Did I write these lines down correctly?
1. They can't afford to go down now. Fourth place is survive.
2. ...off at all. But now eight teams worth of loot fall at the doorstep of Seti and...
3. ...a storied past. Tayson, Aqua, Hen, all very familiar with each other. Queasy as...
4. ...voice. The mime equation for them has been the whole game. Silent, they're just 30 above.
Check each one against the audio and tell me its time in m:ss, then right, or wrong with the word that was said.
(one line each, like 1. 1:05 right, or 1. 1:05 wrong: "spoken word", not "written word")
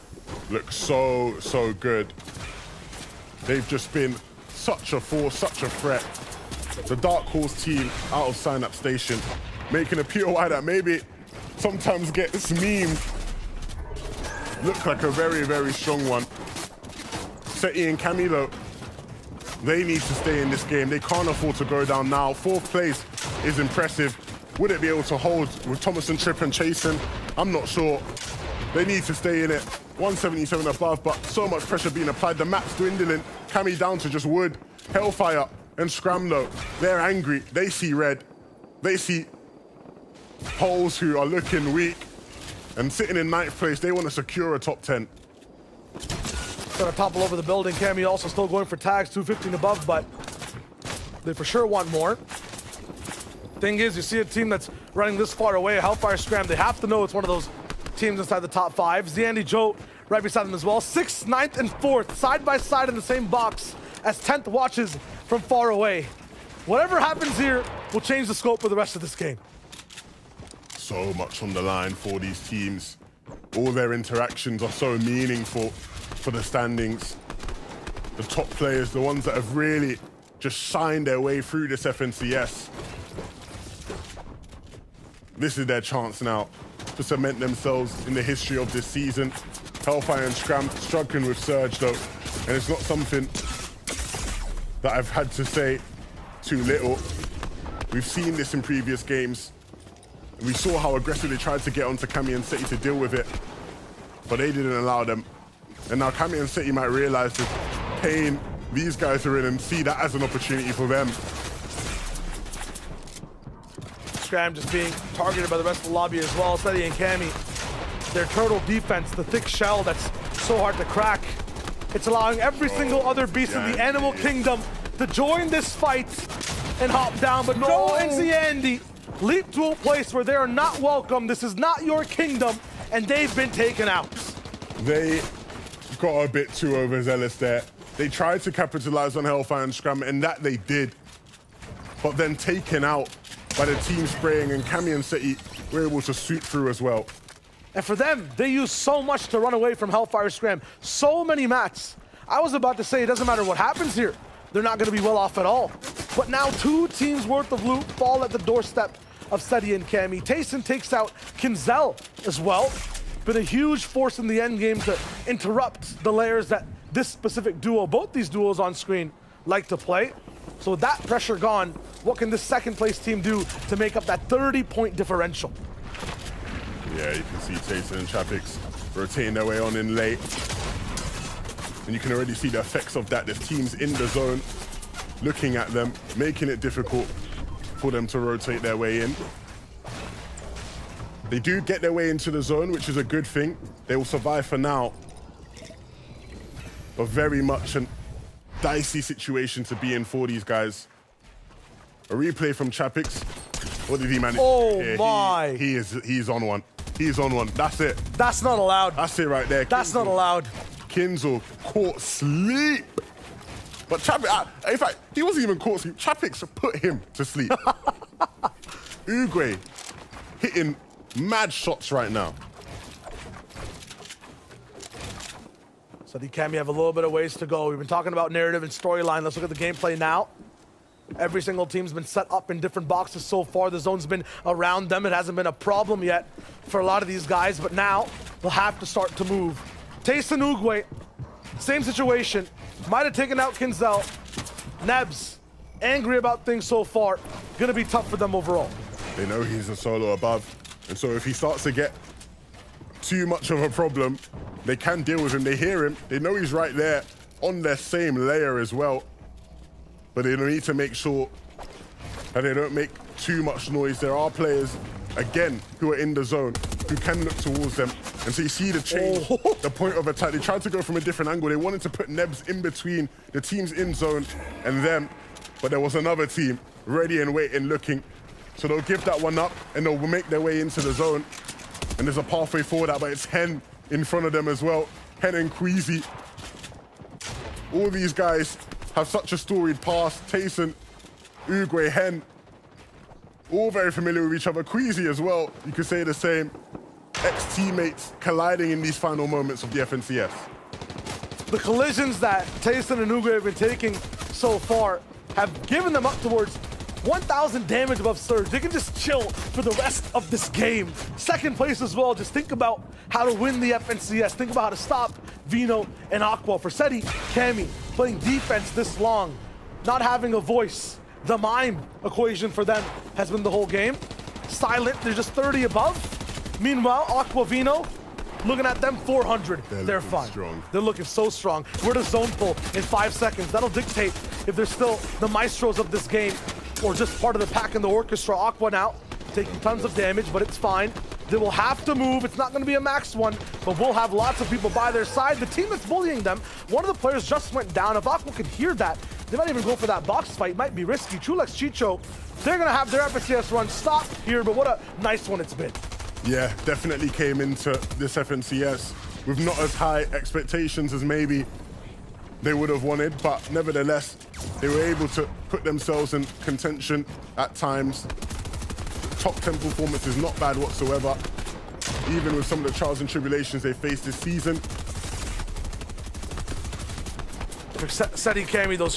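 1. 0:20 wrong: "impressive", not "survive"
2. 2:35 wrong: "two", not "eight"
3. 4:49 wrong: "Uguay", not "Aqua"
4. 5:20 right.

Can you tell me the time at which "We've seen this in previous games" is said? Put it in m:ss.
1:37.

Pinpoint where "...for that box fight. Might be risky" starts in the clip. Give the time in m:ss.
5:49.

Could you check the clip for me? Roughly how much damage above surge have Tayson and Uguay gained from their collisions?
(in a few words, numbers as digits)
1,000.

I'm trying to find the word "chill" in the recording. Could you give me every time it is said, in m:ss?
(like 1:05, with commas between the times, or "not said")
5:08.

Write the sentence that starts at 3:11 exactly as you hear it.
They do get their way into the zone, which is a good thing.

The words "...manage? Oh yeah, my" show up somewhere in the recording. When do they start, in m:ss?
3:24.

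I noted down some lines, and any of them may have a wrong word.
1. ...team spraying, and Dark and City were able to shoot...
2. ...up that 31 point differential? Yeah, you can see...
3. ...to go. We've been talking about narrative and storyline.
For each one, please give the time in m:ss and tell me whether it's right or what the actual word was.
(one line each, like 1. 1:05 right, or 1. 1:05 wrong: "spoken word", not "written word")
1. 2:23 wrong: "Camion", not "Dark"
2. 2:53 wrong: "30", not "31"
3. 3:47 right.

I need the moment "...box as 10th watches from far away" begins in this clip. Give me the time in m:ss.
1:03.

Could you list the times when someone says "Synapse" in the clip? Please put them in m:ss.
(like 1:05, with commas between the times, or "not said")
0:08.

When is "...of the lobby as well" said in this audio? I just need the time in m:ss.
1:55.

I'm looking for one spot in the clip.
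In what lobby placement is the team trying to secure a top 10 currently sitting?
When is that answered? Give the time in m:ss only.
0:43.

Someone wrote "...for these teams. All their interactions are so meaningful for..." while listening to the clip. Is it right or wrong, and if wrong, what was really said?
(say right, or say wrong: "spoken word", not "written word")
right.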